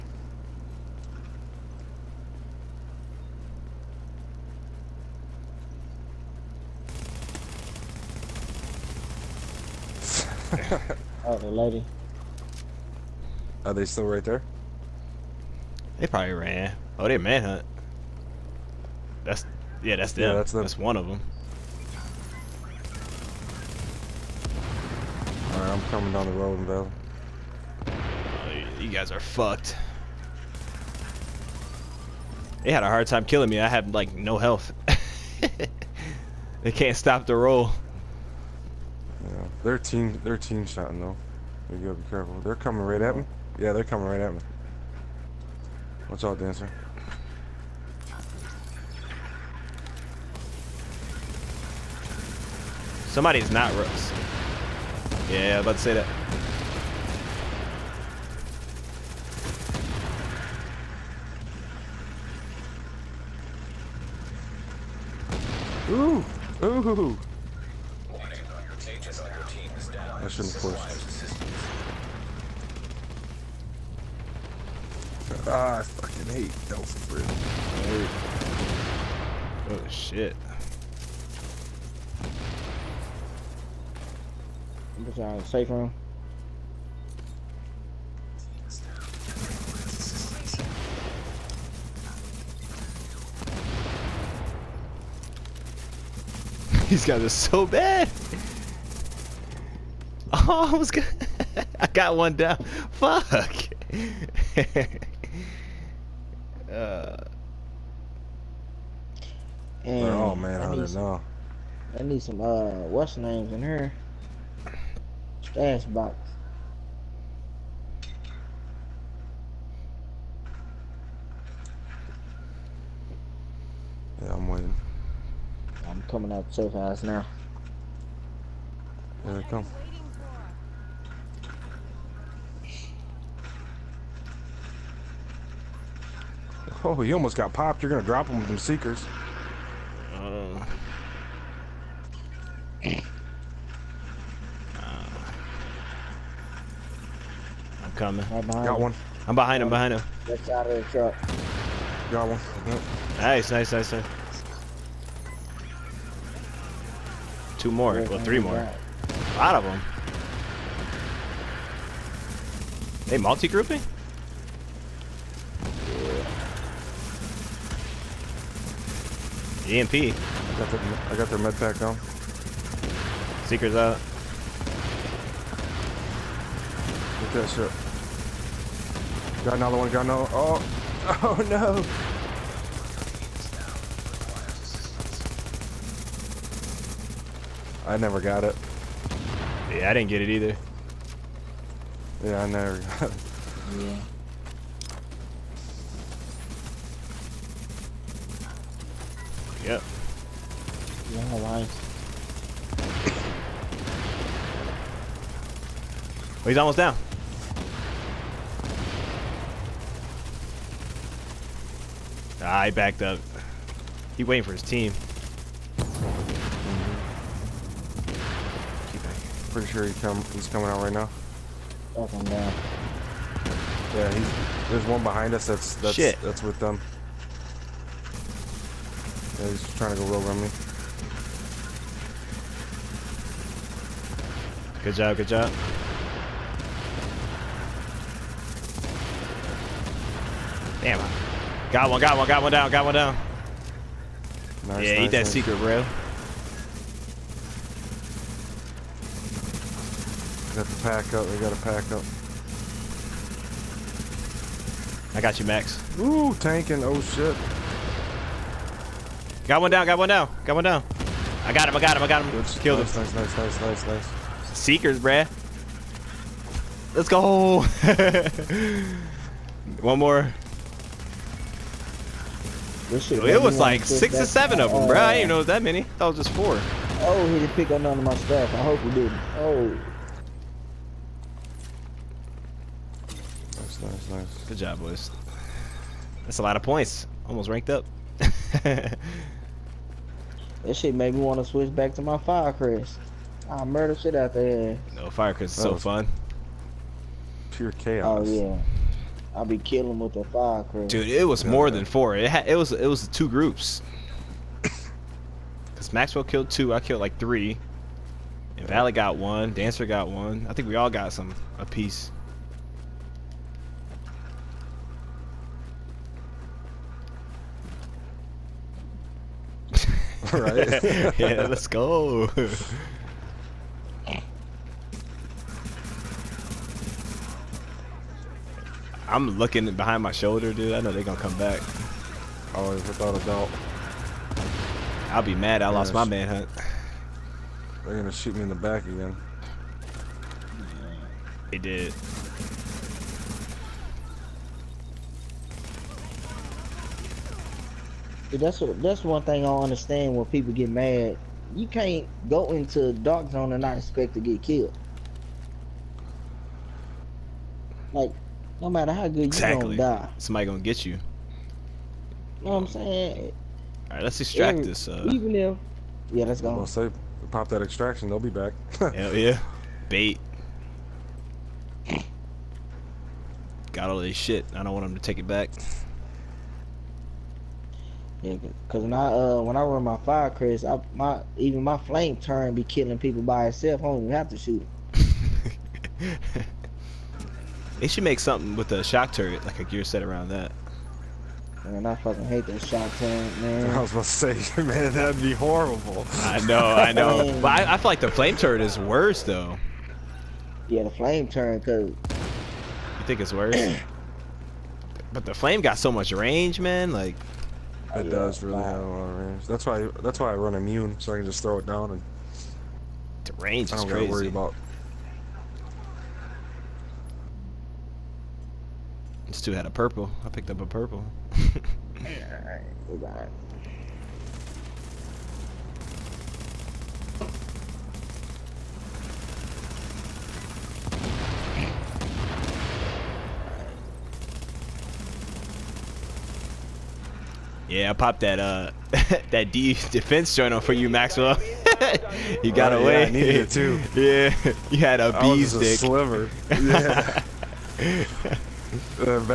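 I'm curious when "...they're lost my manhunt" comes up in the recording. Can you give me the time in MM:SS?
05:35.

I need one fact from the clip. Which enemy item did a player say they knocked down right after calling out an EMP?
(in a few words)
med pack.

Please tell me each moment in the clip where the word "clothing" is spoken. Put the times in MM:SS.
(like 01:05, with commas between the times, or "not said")
not said.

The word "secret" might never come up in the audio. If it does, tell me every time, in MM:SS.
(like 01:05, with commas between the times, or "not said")
04:05.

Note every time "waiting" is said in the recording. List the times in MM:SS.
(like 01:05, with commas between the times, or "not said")
02:04, 03:34.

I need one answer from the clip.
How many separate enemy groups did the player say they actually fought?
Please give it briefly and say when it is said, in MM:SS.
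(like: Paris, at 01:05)
2, at 05:03.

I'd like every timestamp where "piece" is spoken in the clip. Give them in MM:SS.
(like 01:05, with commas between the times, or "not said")
05:11.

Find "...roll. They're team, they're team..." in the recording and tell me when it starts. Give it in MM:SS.
00:37.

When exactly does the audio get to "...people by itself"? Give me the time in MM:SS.
06:22.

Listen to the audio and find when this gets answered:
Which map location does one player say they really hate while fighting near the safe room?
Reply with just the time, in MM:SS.
01:16.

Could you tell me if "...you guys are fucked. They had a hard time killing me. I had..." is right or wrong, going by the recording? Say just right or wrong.
right.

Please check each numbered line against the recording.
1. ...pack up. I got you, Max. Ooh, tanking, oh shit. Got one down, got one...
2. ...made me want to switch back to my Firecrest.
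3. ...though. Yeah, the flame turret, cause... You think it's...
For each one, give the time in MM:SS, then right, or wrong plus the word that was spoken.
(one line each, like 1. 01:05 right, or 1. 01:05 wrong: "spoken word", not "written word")
1. 04:11 right
2. 04:50 right
3. 06:39 right.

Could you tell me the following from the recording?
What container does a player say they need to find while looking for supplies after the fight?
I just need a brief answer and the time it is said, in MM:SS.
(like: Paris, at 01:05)
stash box, at 01:55.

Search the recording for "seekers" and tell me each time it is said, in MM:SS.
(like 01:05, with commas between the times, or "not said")
02:18, 02:53, 04:24.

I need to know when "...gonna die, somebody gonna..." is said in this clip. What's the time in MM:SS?
05:59.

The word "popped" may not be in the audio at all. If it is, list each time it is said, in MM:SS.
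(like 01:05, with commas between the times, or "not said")
02:17, 07:17.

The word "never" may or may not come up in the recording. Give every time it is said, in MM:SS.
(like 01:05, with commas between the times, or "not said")
03:07, 03:12.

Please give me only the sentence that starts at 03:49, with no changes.
Yeah, he's trying to go rogue on me.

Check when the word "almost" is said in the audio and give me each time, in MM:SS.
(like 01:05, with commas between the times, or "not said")
02:17, 03:26, 04:47.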